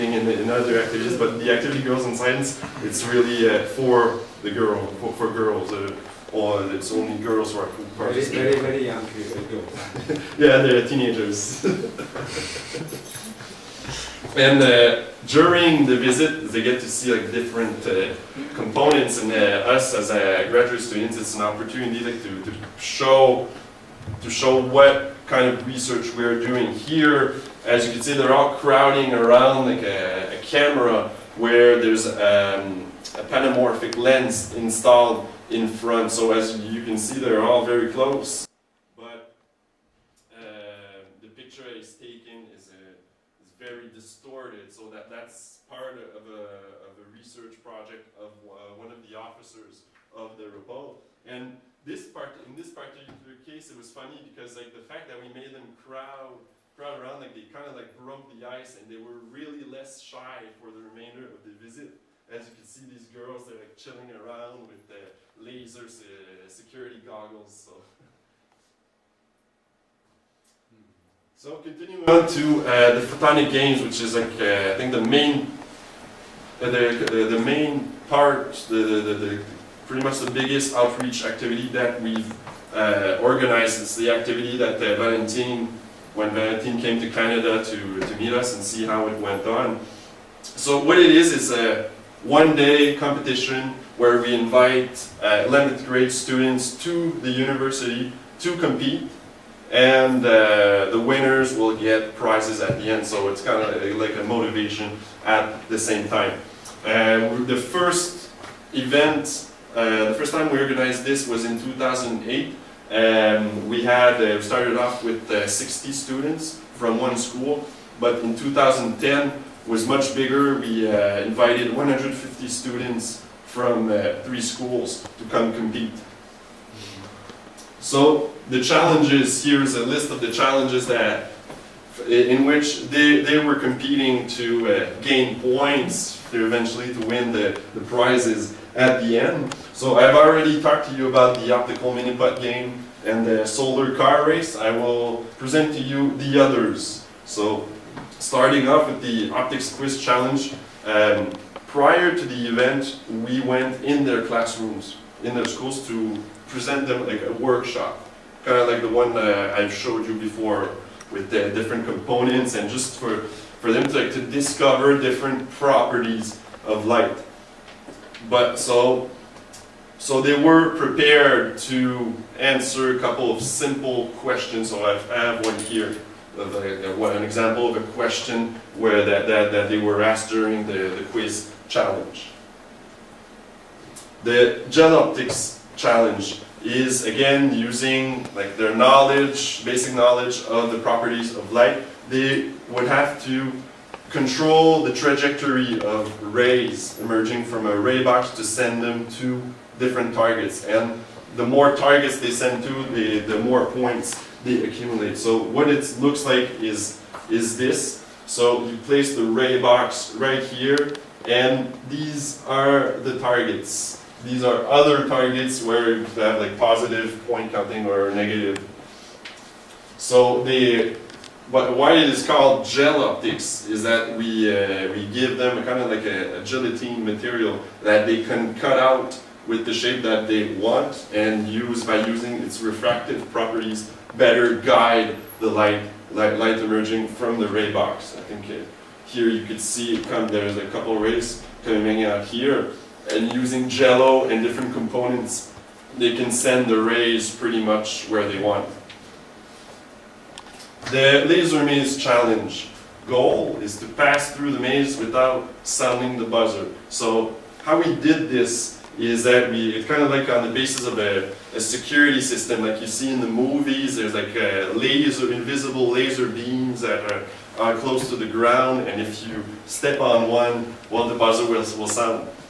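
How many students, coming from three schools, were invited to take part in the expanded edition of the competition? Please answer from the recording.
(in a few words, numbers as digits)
150.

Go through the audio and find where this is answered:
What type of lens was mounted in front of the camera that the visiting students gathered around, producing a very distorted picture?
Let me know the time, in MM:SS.
00:33.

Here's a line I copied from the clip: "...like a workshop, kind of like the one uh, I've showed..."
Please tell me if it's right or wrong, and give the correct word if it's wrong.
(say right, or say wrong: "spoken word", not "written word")
right.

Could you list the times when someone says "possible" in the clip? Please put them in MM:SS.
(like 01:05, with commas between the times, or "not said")
not said.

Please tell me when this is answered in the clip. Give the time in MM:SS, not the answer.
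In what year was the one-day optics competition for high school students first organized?
01:51.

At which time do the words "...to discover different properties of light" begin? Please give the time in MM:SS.
02:44.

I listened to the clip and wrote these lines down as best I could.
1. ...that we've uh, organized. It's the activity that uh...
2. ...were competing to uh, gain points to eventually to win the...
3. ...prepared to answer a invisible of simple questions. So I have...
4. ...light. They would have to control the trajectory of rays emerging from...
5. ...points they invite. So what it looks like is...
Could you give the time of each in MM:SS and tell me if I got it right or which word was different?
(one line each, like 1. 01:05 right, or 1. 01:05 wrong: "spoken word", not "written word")
1. 01:21 right
2. 02:13 right
3. 02:50 wrong: "couple", not "invisible"
4. 03:11 right
5. 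03:23 wrong: "accumulate", not "invite".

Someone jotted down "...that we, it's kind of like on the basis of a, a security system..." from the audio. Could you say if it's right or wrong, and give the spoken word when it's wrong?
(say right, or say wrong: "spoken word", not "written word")
right.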